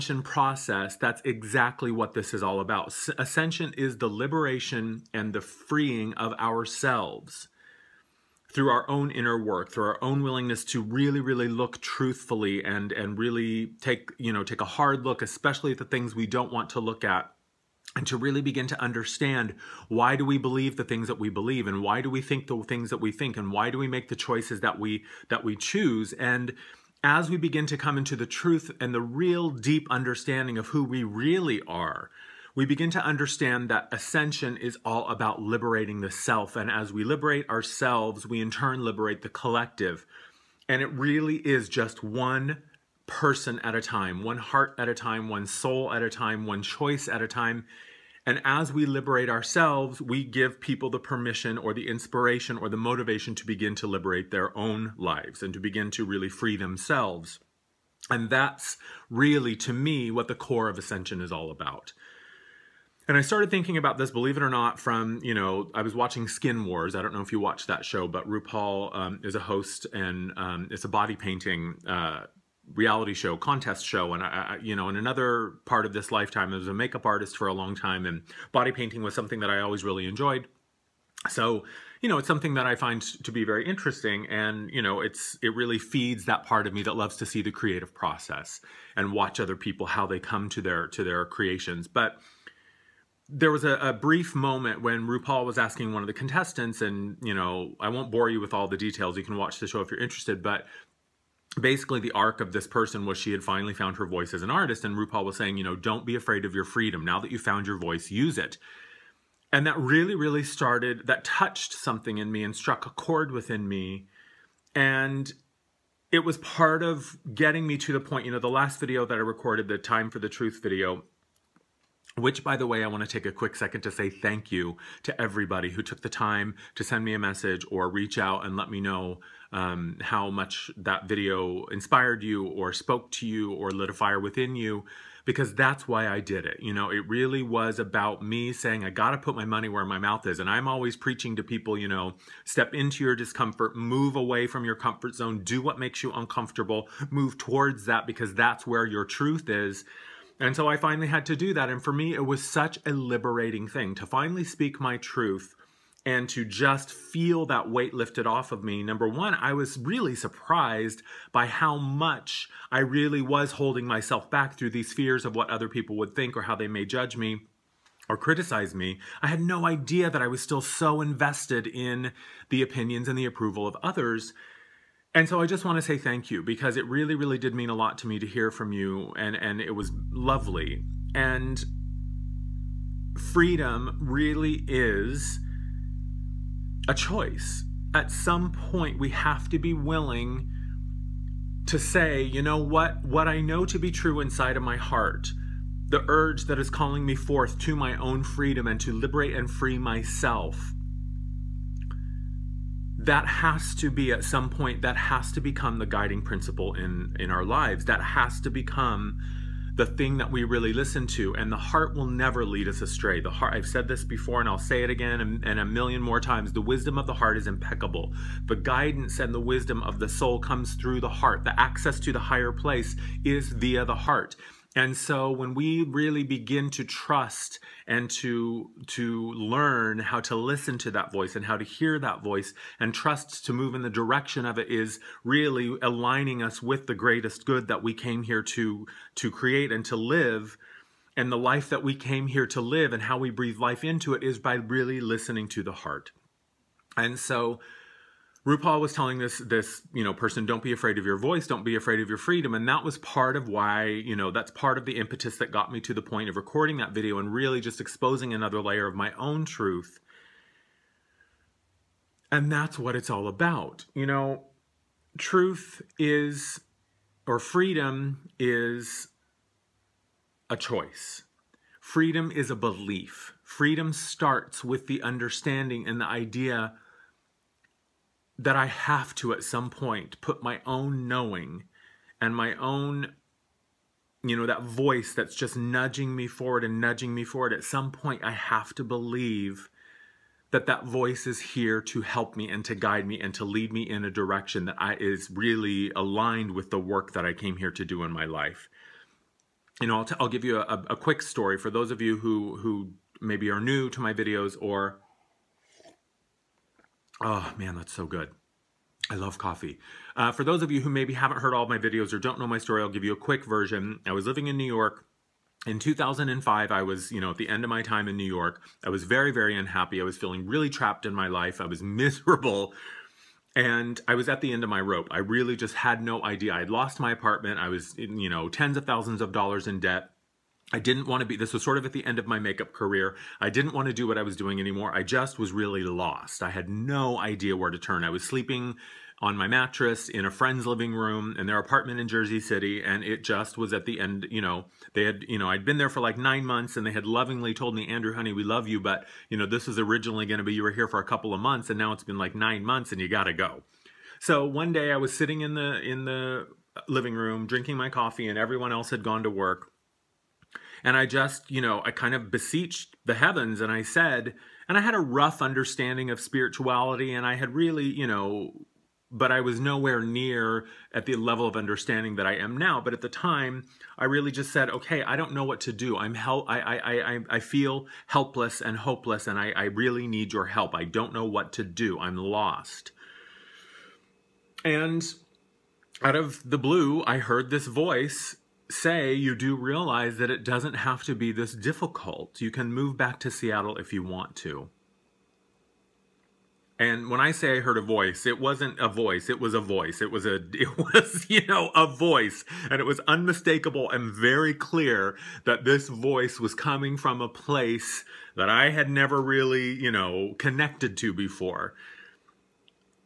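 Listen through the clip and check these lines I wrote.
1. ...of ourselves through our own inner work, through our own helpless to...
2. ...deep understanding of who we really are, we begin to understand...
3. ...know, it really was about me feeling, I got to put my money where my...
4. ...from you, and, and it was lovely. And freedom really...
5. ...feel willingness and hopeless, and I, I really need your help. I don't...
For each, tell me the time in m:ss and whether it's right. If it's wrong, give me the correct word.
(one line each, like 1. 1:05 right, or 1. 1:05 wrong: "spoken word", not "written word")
1. 0:06 wrong: "willingness", not "helpless"
2. 0:29 right
3. 2:16 wrong: "saying", not "feeling"
4. 2:58 right
5. 6:17 wrong: "helpless", not "willingness".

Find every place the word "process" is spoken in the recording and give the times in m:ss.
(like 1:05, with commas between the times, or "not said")
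0:00, 1:27.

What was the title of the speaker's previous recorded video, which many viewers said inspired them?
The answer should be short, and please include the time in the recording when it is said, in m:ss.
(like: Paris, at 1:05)
Time for the Truth, at 1:59.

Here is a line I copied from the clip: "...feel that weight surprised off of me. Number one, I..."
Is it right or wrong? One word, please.
wrong.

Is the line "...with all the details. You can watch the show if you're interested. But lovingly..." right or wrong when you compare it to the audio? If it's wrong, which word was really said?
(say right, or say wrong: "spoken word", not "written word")
wrong: "basically", not "lovingly".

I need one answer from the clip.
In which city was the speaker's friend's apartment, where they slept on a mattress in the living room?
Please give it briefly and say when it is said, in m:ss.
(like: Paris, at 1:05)
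Jersey City, at 5:42.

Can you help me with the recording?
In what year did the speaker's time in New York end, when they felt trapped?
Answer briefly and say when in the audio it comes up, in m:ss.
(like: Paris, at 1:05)
2005, at 5:15.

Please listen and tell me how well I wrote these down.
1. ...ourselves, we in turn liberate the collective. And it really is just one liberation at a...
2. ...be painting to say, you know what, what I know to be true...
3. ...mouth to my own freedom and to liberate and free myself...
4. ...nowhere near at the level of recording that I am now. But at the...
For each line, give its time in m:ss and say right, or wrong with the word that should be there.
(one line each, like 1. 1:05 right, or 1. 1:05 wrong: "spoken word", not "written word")
1. 0:37 wrong: "person", not "liberation"
2. 3:09 wrong: "willing", not "painting"
3. 3:17 wrong: "forth", not "mouth"
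4. 6:09 wrong: "understanding", not "recording".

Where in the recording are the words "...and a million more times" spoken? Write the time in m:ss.
3:35.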